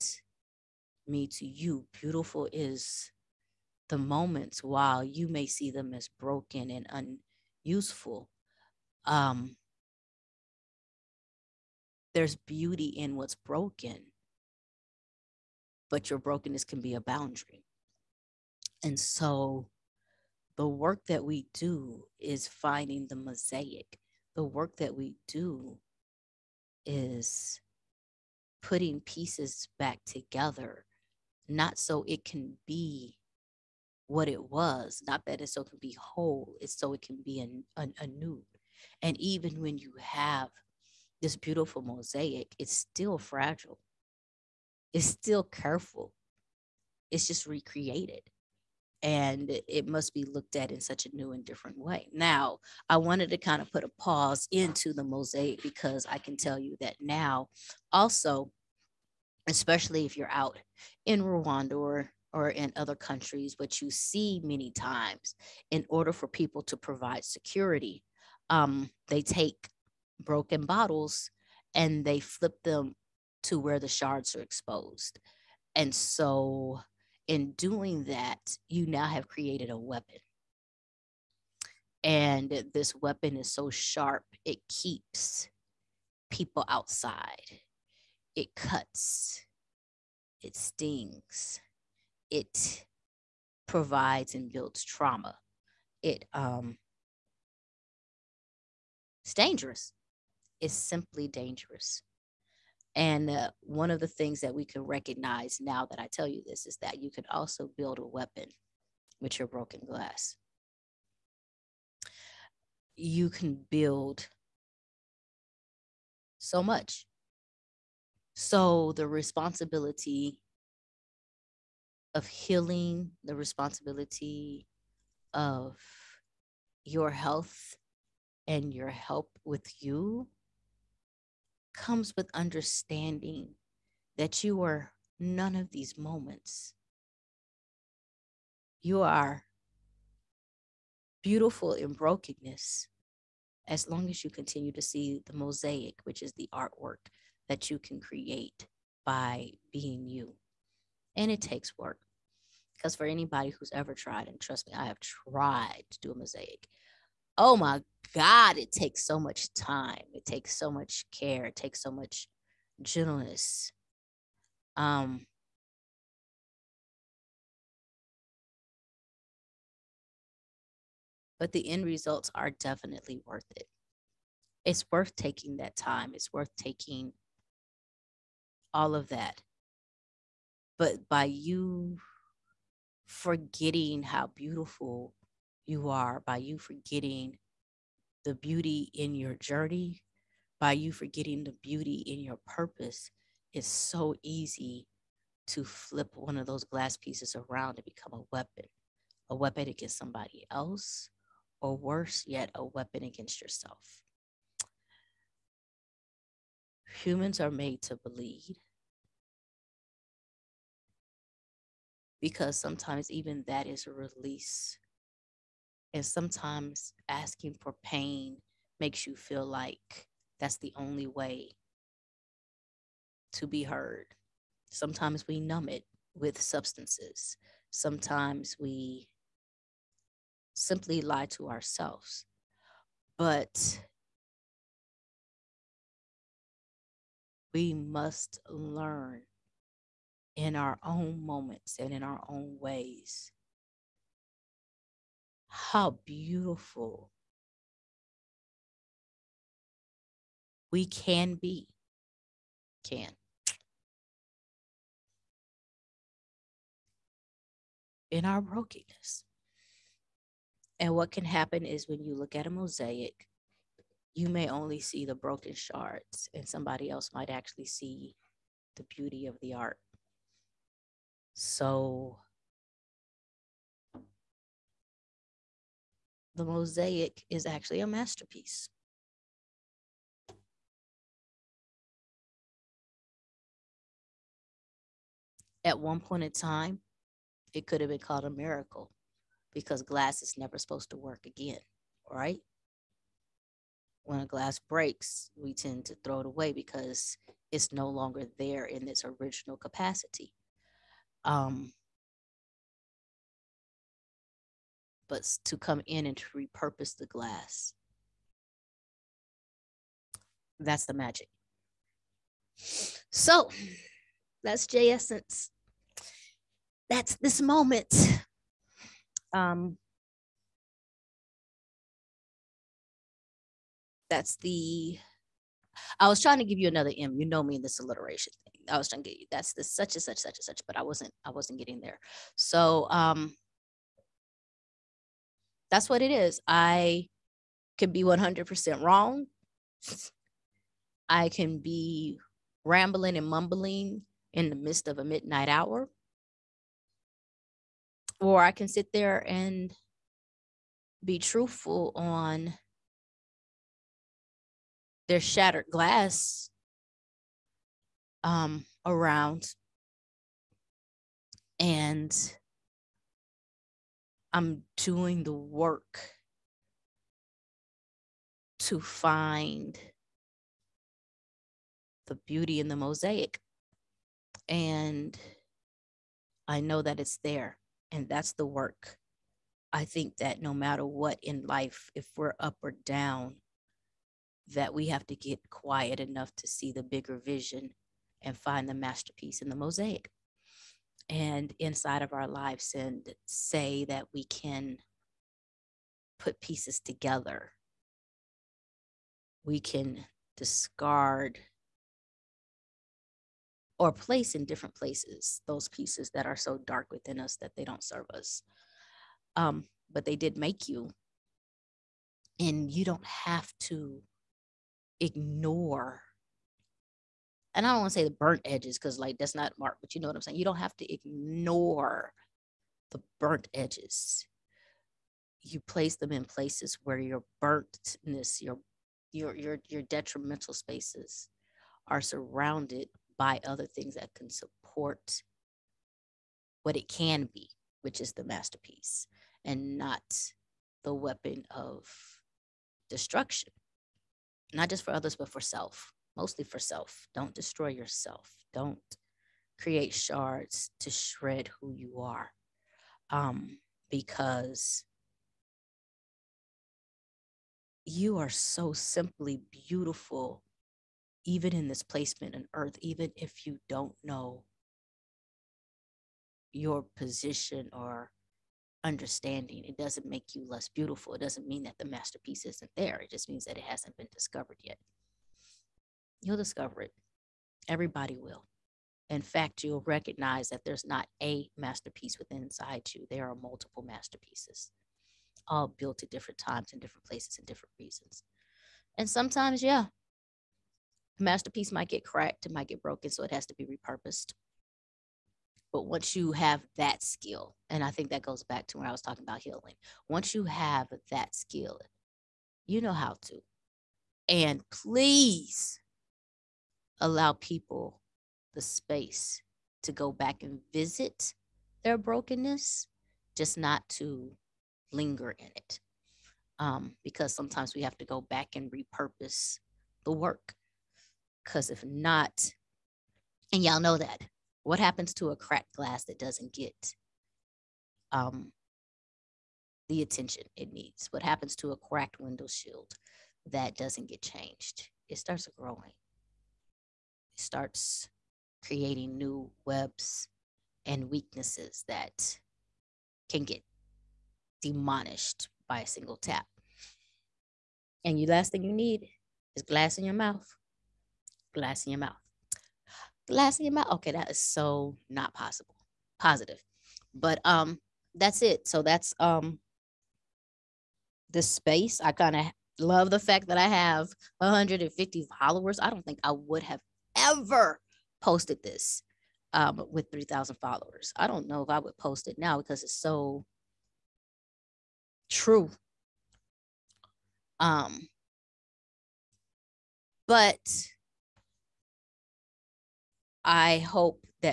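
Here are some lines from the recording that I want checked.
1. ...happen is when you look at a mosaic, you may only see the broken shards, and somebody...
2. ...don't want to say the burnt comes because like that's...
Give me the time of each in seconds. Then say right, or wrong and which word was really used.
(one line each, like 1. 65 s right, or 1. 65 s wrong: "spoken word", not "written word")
1. 261 s right
2. 417 s wrong: "edges", not "comes".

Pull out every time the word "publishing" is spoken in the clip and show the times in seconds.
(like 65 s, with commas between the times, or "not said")
not said.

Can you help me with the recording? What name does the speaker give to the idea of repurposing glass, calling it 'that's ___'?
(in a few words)
Jai Essence.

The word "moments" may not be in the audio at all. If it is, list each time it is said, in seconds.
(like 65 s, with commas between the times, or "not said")
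3 s, 135 s, 241 s, 317 s.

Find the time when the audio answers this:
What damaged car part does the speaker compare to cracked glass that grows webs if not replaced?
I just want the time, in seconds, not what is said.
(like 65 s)
532 s.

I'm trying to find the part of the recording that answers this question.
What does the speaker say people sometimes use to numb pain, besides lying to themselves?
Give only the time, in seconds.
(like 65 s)
226 s.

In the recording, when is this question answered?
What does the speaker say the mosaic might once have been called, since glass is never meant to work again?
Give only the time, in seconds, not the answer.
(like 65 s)
288 s.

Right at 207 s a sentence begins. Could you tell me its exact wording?
Humans are made to bleed because sometimes even that is a release.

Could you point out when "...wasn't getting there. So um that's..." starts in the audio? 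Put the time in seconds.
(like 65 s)
331 s.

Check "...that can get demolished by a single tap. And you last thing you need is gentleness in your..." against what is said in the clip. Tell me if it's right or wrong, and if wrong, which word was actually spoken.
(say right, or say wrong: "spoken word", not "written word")
wrong: "glass", not "gentleness".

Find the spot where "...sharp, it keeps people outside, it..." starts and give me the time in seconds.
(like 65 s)
83 s.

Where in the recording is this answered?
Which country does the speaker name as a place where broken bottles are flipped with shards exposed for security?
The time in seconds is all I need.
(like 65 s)
61 s.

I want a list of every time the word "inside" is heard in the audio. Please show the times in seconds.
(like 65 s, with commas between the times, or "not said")
391 s, 482 s.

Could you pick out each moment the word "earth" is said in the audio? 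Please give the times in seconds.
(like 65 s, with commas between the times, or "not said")
462 s.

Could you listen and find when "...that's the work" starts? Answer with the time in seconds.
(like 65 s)
378 s.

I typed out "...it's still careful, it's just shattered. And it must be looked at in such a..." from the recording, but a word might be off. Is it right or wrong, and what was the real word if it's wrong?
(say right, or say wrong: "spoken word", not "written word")
wrong: "recreated", not "shattered".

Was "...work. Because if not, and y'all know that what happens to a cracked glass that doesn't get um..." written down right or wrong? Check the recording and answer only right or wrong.
right.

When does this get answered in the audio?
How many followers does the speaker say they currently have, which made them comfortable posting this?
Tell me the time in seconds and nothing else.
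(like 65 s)
564 s.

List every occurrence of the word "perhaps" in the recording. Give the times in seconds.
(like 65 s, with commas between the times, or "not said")
not said.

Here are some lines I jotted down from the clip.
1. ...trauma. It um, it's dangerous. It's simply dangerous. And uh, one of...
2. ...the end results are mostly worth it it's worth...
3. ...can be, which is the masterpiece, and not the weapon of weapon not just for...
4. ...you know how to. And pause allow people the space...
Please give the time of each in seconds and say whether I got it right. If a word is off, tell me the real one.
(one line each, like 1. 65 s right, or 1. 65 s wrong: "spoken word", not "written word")
1. 94 s right
2. 171 s wrong: "definitely", not "mostly"
3. 436 s wrong: "destruction", not "weapon"
4. 502 s wrong: "please", not "pause".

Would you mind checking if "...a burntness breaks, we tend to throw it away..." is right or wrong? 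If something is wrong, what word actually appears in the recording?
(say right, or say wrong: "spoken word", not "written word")
wrong: "glass", not "burntness".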